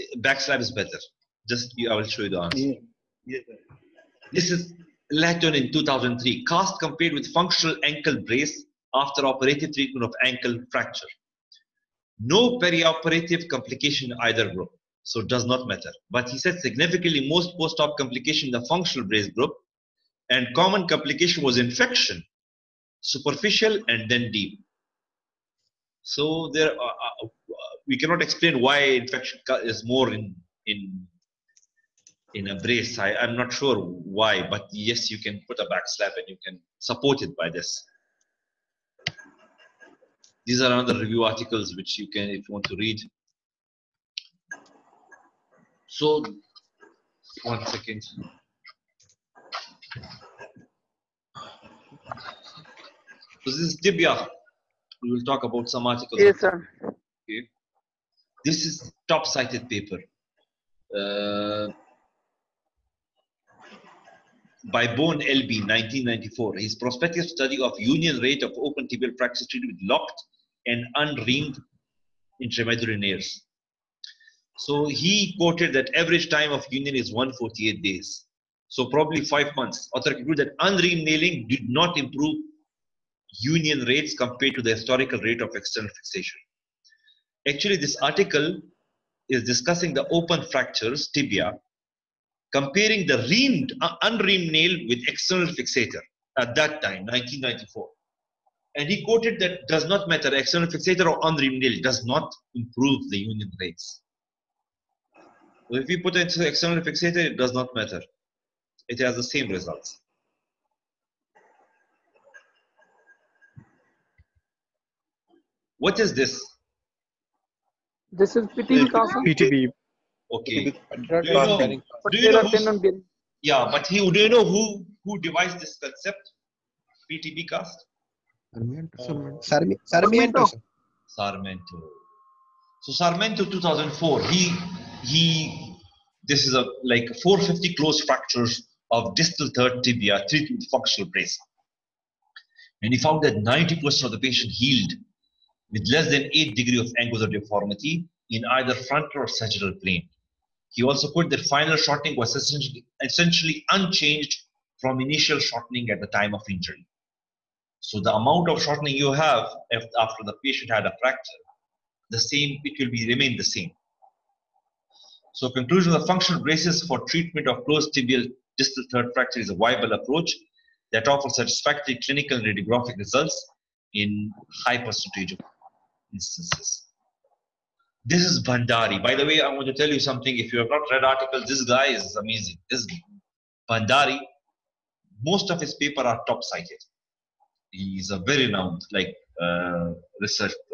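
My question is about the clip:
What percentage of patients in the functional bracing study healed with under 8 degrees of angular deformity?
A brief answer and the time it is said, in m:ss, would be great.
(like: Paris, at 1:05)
90%, at 2:23.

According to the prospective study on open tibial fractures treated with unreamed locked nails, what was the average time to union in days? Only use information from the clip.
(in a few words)
148 days.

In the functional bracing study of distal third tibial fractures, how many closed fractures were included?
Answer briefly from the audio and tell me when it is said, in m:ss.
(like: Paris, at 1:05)
450, at 2:17.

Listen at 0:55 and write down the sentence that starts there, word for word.
We will talk about some articles.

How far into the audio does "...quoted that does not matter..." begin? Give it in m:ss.
1:39.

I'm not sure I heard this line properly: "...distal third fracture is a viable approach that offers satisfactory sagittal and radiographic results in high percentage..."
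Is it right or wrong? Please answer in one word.
wrong.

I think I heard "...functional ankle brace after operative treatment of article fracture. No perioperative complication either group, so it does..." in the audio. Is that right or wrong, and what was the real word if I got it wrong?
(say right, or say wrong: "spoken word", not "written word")
wrong: "ankle", not "article".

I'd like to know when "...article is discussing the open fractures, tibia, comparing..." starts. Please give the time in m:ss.
1:27.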